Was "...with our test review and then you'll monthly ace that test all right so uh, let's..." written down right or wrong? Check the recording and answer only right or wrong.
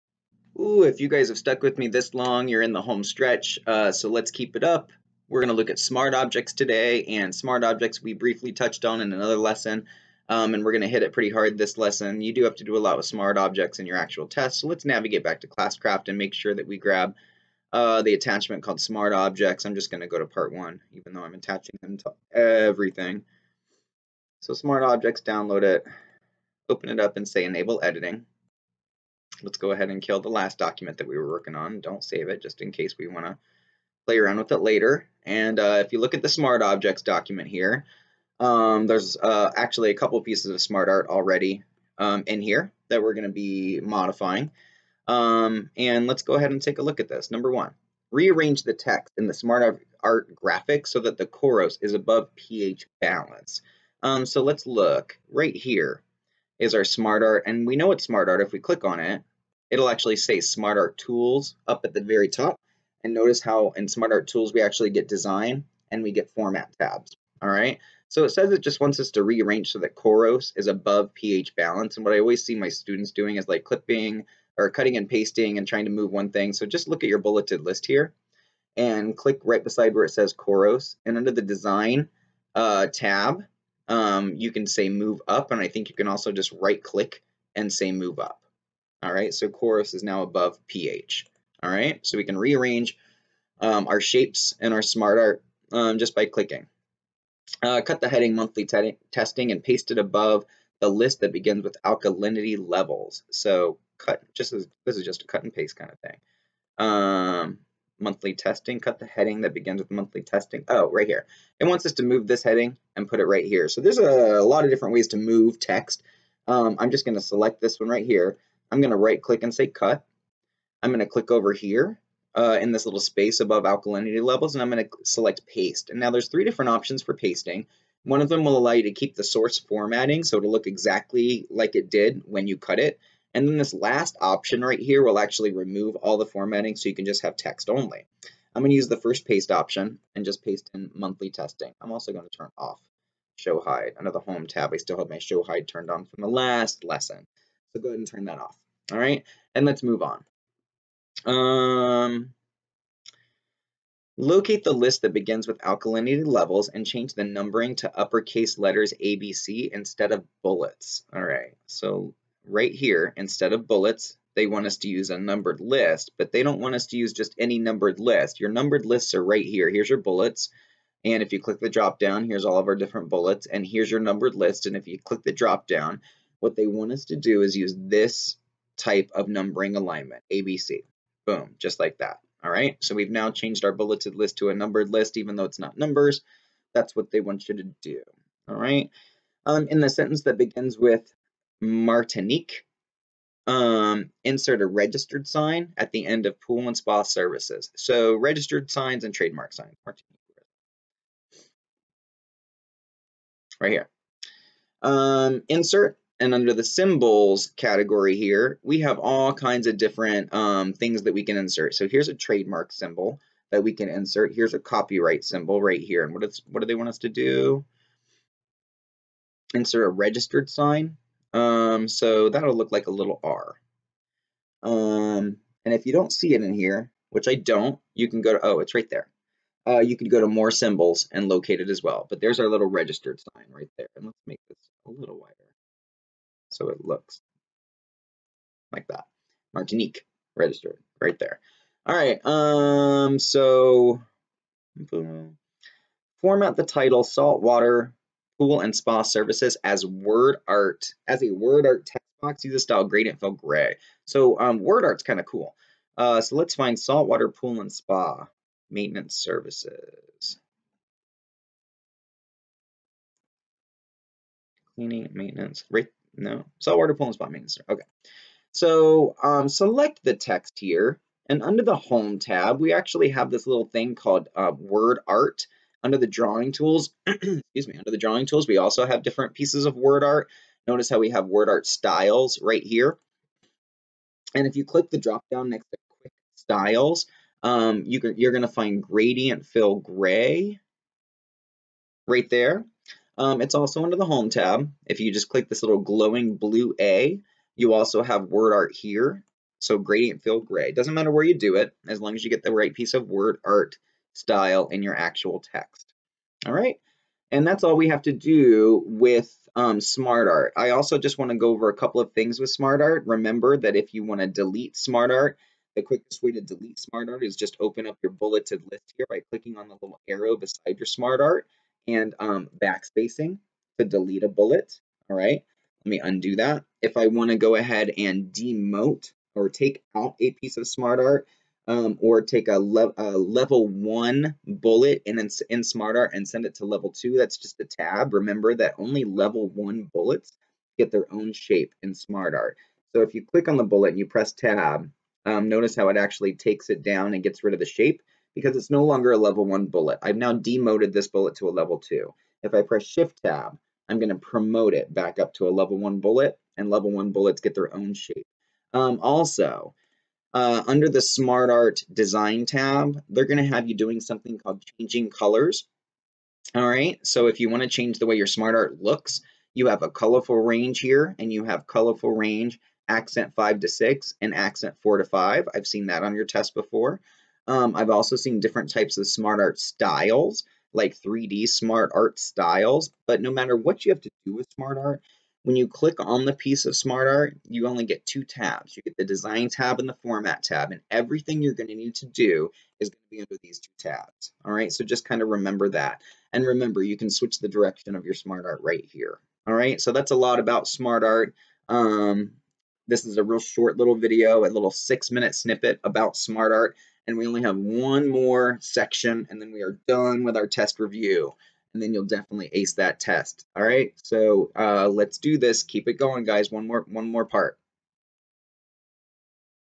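wrong.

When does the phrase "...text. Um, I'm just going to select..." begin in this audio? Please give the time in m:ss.
1:55.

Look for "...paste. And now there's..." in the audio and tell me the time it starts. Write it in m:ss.
2:05.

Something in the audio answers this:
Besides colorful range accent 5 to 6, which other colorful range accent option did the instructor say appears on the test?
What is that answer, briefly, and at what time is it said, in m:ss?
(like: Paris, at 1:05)
Accent 4 to 5, at 6:14.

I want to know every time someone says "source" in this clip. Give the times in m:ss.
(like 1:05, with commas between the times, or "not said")
2:09.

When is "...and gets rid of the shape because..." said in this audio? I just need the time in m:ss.
5:47.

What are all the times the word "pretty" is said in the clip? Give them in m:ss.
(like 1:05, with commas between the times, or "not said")
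0:11.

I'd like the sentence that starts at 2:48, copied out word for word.
Your numbered lists are right here.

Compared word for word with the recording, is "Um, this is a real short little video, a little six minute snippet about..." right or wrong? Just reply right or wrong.
right.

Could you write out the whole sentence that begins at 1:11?
And what I always see my students doing is like clipping or cutting and pasting and trying to move one thing.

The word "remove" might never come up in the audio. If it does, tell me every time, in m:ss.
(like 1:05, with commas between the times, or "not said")
2:15.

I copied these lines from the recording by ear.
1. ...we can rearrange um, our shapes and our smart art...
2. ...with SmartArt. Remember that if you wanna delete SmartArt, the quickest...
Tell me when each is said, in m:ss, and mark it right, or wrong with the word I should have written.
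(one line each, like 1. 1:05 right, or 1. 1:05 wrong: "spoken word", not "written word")
1. 1:32 right
2. 5:12 right.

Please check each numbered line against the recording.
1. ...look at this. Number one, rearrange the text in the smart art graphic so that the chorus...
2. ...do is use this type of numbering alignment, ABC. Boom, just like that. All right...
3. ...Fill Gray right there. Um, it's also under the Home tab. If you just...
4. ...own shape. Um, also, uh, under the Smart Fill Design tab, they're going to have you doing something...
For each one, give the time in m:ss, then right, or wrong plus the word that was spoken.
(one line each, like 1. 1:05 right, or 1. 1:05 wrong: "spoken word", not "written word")
1. 0:46 right
2. 2:57 right
3. 4:49 right
4. 5:57 wrong: "Art", not "Fill".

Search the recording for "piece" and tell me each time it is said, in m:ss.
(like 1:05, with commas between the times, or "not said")
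0:40, 4:39, 5:02, 5:30, 6:26.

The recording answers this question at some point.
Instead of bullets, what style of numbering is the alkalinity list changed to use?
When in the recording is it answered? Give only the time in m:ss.
2:37.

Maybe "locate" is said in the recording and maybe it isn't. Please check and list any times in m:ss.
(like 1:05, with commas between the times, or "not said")
2:34, 3:51.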